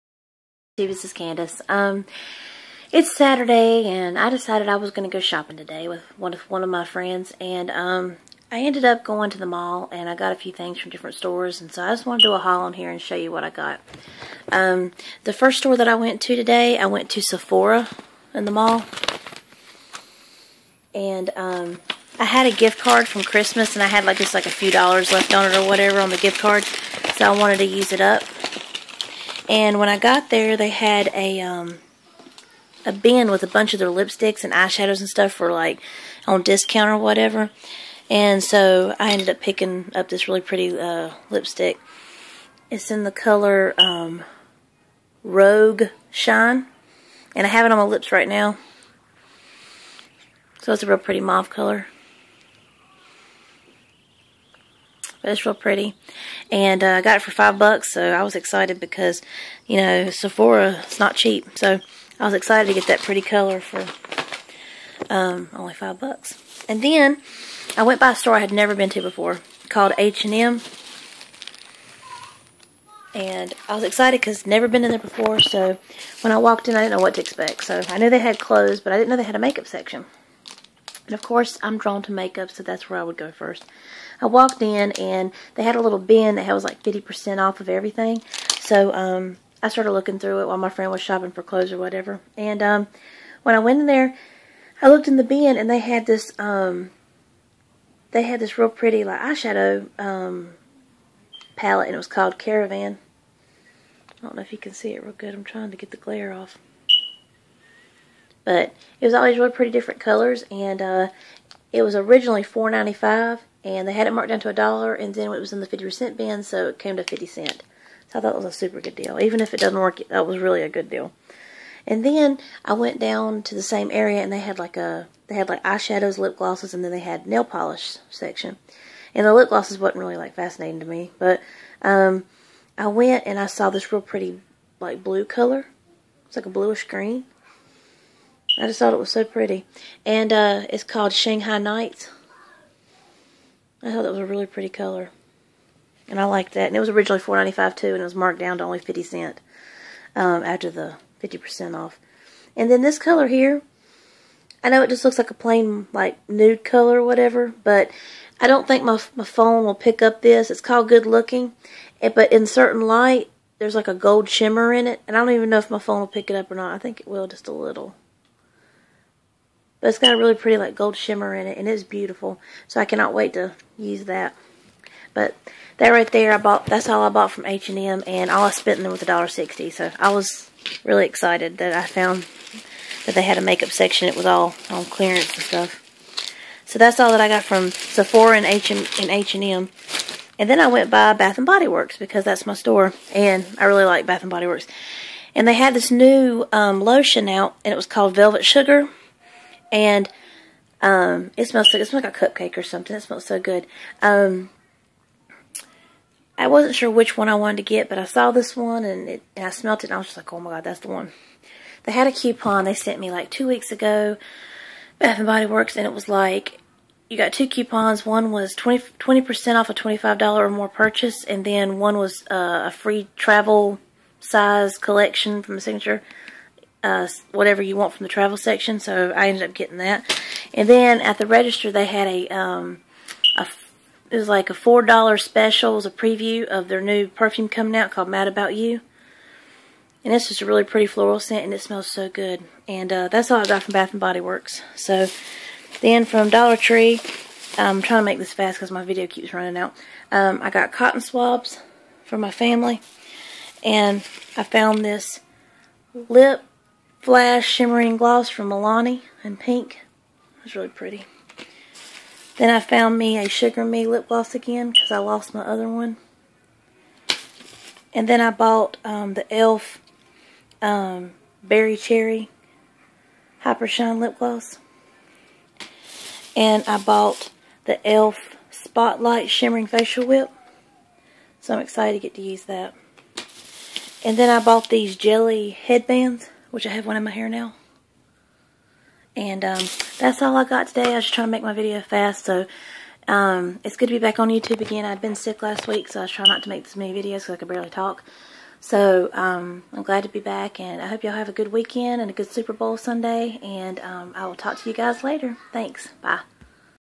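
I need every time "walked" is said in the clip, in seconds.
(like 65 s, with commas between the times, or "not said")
76 s, 84 s.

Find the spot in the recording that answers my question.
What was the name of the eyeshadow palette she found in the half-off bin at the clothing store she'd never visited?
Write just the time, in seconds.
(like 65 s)
102 s.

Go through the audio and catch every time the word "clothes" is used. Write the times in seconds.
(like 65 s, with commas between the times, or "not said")
78 s, 91 s.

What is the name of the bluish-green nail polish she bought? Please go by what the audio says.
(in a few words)
Shanghai Nights.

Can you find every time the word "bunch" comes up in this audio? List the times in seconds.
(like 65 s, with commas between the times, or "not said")
33 s.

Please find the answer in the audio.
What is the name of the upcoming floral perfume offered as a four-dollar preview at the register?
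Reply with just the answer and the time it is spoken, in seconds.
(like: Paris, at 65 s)
Mad About You, at 238 s.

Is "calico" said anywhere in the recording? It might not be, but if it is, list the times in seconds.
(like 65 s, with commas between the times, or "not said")
not said.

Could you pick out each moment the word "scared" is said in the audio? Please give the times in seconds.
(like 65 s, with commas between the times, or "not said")
not said.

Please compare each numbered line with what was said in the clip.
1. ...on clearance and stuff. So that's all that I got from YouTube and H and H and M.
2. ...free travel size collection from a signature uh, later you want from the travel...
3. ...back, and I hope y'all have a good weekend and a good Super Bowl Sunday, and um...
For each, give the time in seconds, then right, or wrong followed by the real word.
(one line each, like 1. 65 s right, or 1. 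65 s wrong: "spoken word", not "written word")
1. 184 s wrong: "Sephora", not "YouTube"
2. 222 s wrong: "whatever", not "later"
3. 300 s right.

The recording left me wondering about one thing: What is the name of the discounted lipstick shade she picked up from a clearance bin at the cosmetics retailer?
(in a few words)
Rogue Shine.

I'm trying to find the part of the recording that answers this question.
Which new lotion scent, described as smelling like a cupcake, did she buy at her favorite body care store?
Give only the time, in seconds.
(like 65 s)
198 s.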